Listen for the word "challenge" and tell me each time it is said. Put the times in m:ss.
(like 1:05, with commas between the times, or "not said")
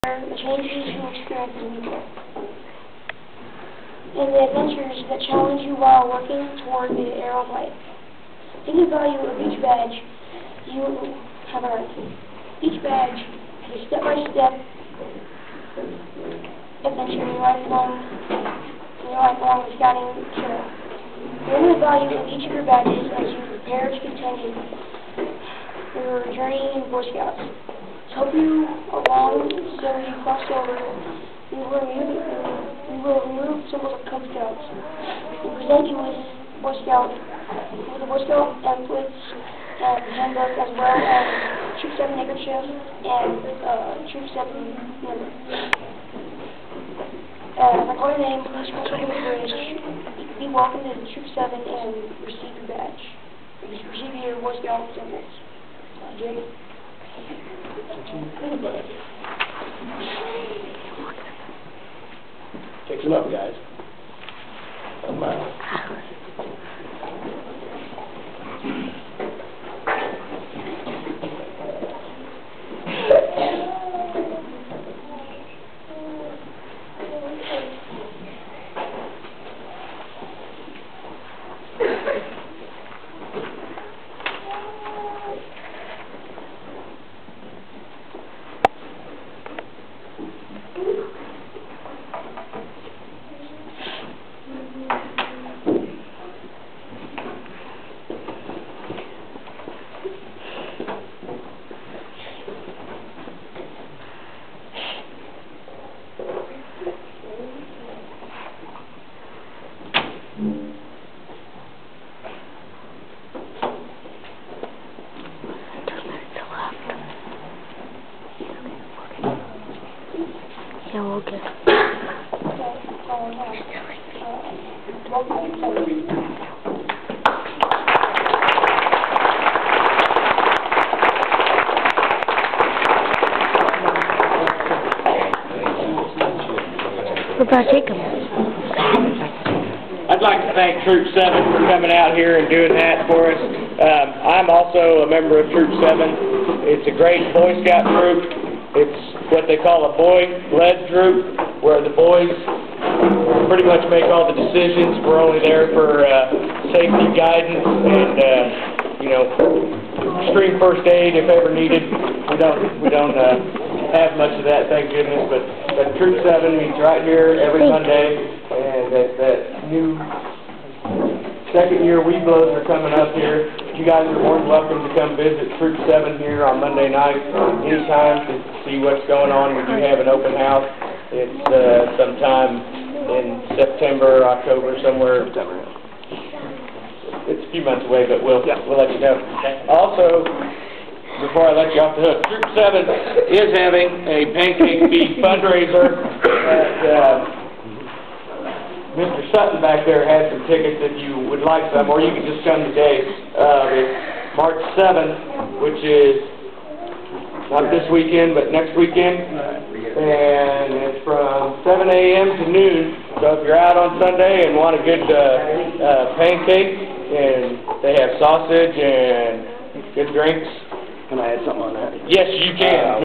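0:05.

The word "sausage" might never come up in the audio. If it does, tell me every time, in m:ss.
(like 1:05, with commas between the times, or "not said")
3:38.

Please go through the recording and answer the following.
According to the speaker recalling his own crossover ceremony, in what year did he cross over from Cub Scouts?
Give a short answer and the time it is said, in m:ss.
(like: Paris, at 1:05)
1970, at 0:29.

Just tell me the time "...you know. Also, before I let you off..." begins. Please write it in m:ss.
3:08.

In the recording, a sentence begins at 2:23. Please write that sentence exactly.
Um, I'm also a member of Troop 7.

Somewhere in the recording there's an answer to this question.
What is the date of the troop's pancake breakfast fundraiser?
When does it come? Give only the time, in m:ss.
3:24.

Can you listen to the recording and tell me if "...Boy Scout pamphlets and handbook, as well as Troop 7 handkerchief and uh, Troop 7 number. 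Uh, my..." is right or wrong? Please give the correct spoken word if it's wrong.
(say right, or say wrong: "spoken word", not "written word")
right.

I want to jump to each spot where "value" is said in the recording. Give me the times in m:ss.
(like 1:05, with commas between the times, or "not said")
0:08, 0:21.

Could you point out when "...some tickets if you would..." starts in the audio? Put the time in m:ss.
3:20.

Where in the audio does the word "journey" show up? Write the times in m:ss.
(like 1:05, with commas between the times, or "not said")
0:26.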